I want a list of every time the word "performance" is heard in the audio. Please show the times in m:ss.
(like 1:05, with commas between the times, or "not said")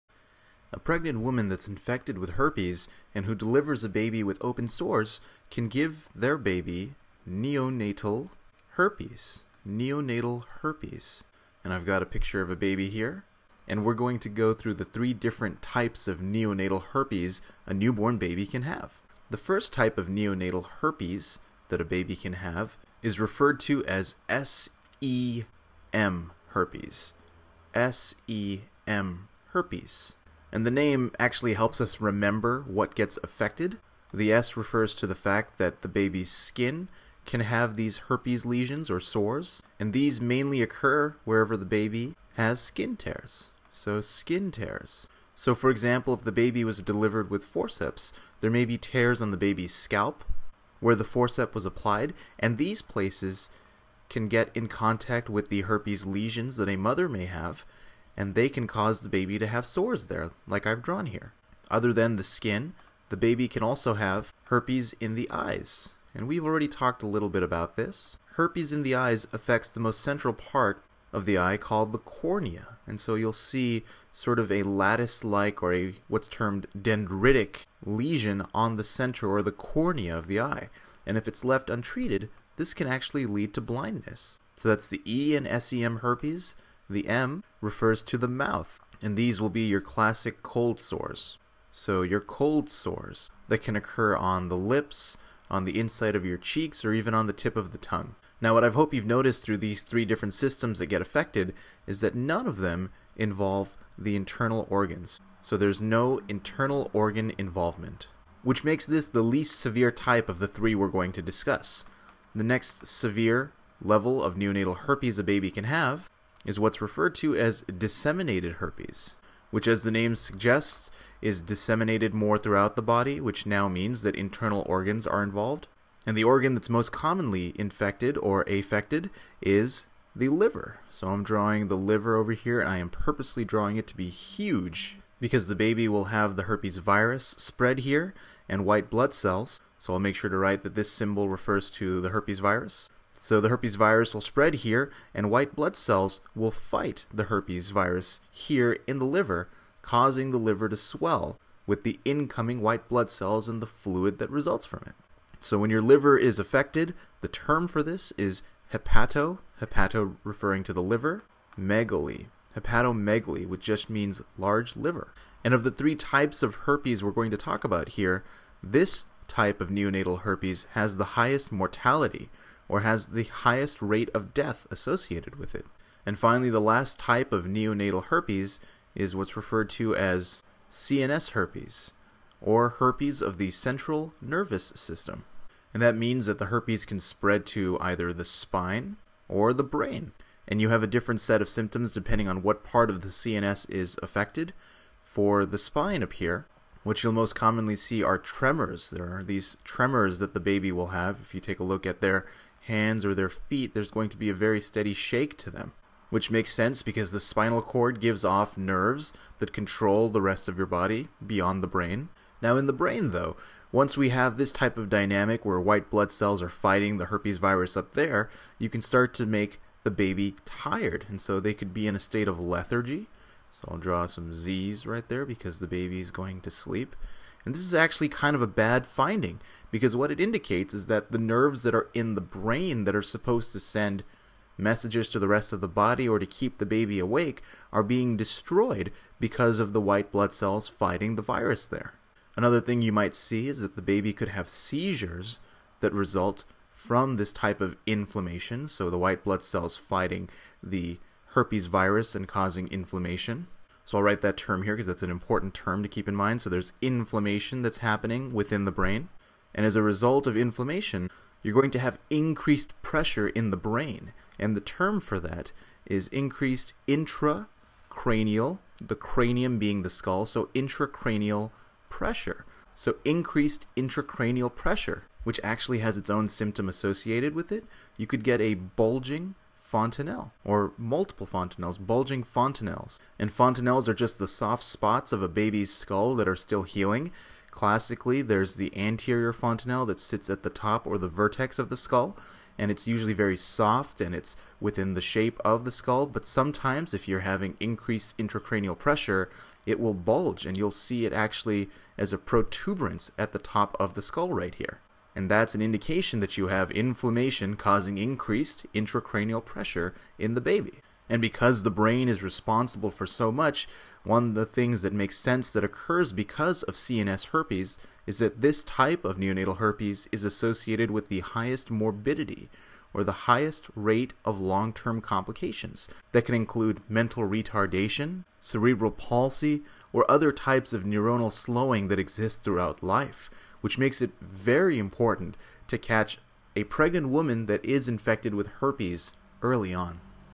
not said.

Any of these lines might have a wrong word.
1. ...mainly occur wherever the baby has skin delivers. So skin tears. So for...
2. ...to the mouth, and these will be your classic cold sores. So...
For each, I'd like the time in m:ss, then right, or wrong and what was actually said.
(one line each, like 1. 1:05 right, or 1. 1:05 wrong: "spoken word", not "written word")
1. 0:40 wrong: "tears", not "delivers"
2. 1:28 right.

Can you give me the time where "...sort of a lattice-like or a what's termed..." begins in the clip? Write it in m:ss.
1:14.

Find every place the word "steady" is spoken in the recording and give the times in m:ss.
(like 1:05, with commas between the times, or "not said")
3:24.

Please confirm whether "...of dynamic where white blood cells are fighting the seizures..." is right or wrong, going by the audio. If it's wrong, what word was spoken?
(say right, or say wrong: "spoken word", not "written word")
wrong: "herpes", not "seizures".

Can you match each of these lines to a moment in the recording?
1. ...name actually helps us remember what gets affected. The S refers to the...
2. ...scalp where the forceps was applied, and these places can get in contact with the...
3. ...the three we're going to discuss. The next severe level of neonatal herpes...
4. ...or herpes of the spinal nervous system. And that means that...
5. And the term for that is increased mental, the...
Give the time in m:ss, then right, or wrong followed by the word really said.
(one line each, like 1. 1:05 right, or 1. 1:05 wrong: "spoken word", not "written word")
1. 0:30 right
2. 0:49 right
3. 1:50 right
4. 3:02 wrong: "central", not "spinal"
5. 4:24 wrong: "intracranial", not "mental".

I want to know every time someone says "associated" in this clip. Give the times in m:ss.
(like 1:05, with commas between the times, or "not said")
2:54, 4:36, 5:20.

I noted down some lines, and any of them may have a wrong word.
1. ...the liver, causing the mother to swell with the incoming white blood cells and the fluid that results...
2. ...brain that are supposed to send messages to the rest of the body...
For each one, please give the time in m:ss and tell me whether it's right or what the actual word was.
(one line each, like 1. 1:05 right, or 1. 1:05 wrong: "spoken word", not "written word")
1. 2:28 wrong: "liver", not "mother"
2. 3:52 right.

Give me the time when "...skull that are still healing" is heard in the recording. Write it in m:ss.
4:45.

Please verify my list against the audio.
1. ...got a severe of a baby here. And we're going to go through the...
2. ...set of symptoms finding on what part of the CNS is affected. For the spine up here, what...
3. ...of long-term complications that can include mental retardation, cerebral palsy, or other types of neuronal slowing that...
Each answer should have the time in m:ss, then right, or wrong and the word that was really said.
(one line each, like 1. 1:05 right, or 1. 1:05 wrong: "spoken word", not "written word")
1. 0:11 wrong: "picture", not "severe"
2. 3:11 wrong: "depending", not "finding"
3. 5:24 right.